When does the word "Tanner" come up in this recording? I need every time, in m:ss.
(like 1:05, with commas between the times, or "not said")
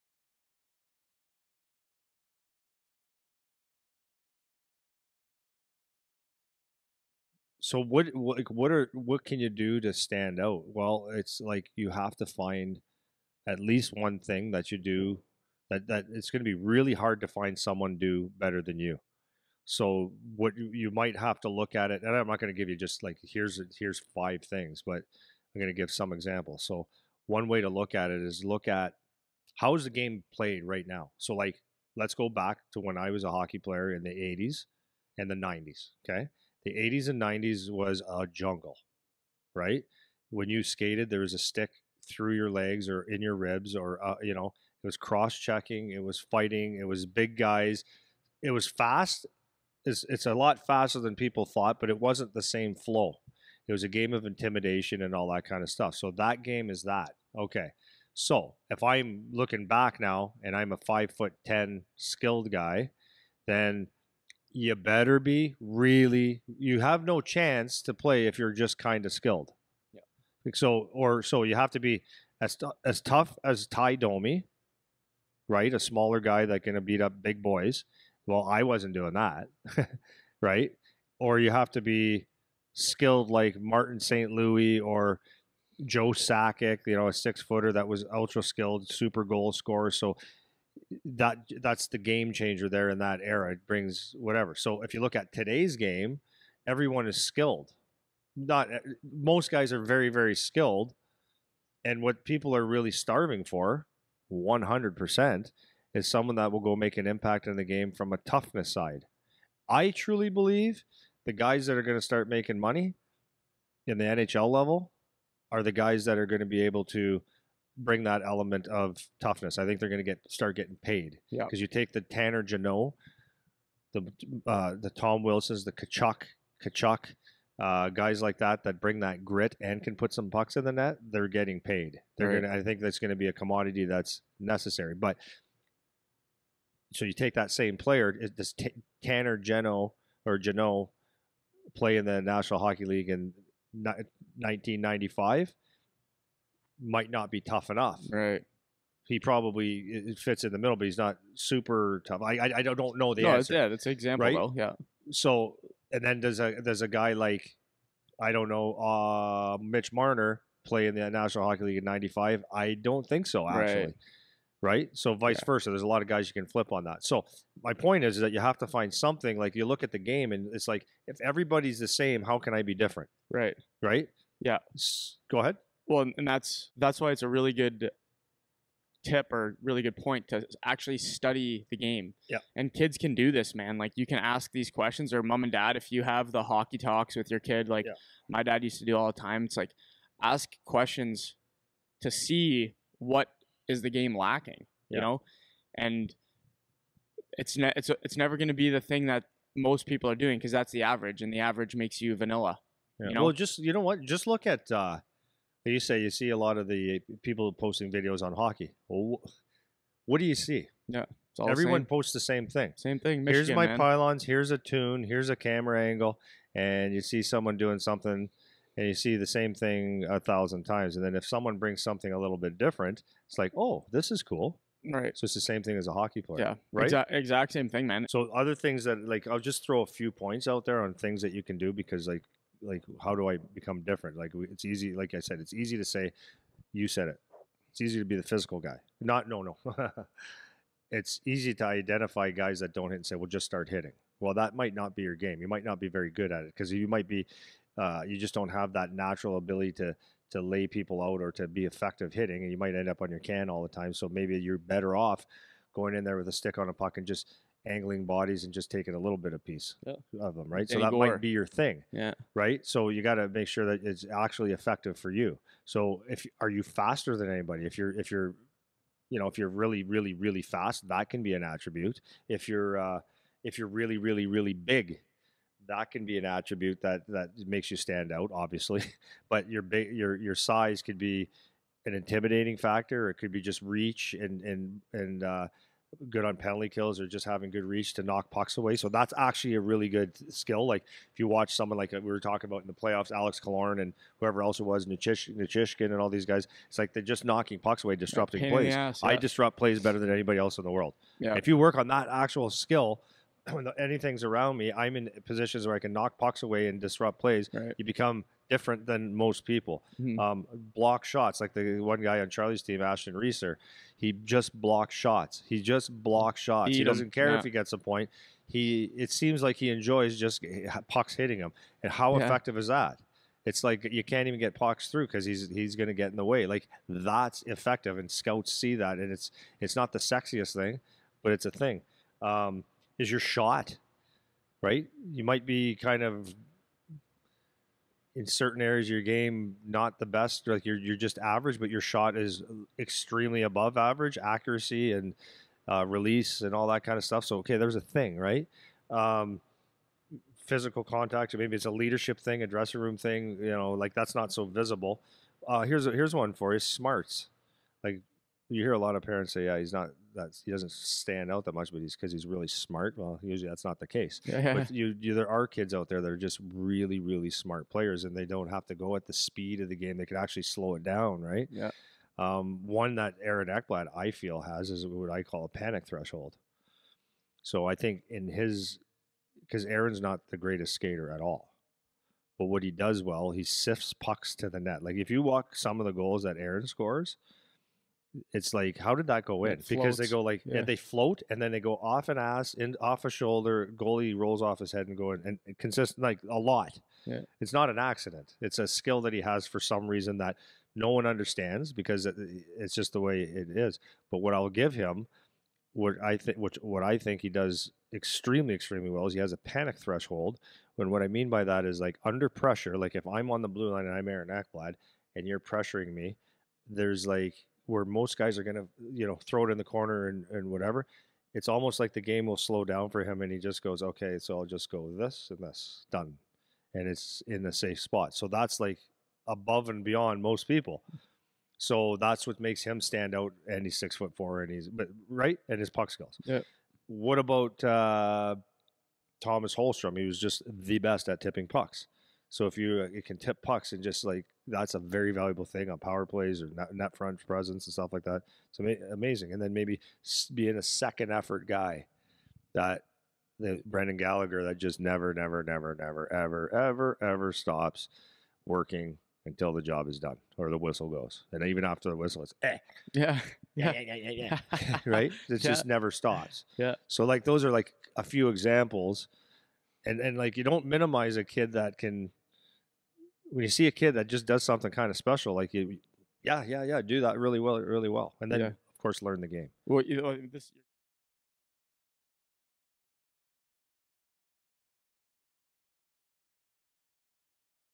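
2:02, 2:19.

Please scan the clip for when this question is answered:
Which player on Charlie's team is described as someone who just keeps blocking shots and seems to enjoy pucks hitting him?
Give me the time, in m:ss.
5:12.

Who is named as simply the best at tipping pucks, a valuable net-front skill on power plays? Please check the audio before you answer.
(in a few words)
Thomas Holmstrom.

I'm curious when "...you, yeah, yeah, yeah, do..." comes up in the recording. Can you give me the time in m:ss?
7:55.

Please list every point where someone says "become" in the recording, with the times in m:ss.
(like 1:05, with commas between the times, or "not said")
3:53, 5:07.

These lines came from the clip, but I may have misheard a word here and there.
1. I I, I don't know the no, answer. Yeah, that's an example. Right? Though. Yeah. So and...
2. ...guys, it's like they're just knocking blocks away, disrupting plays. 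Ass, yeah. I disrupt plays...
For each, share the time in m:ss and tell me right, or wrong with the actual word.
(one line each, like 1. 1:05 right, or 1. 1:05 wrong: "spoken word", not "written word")
1. 2:32 right
2. 4:56 wrong: "pucks", not "blocks".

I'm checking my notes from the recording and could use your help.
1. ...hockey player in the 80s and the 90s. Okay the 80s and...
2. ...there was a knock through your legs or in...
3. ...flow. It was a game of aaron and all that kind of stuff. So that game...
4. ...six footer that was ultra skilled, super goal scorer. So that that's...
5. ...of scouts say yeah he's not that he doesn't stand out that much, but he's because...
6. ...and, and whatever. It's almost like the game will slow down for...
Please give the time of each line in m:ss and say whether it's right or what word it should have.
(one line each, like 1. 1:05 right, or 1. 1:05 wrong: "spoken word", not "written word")
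1. 0:33 right
2. 0:41 wrong: "stick", not "knock"
3. 0:52 wrong: "intimidation", not "aaron"
4. 1:27 right
5. 5:58 wrong: "parents", not "scouts"
6. 7:00 right.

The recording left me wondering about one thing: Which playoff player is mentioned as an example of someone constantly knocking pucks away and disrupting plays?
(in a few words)
Alex Killorn.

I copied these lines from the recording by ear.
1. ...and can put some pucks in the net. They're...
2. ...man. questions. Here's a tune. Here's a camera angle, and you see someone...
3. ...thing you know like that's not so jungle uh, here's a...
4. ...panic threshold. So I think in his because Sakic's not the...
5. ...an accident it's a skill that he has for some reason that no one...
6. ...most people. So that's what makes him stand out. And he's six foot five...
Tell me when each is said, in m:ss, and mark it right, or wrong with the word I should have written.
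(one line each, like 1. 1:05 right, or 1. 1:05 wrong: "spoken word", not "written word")
1. 2:09 right
2. 3:33 wrong: "pylons", not "questions"
3. 5:52 wrong: "visible", not "jungle"
4. 6:15 wrong: "Aaron", not "Sakic"
5. 6:37 right
6. 7:10 wrong: "four", not "five".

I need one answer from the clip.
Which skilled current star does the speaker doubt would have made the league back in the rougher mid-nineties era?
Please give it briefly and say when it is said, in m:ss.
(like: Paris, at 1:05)
Mitch Marner, at 2:39.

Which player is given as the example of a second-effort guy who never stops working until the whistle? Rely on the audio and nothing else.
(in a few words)
Brendan Gallagher.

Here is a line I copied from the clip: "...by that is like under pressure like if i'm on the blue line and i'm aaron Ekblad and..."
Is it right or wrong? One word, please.
right.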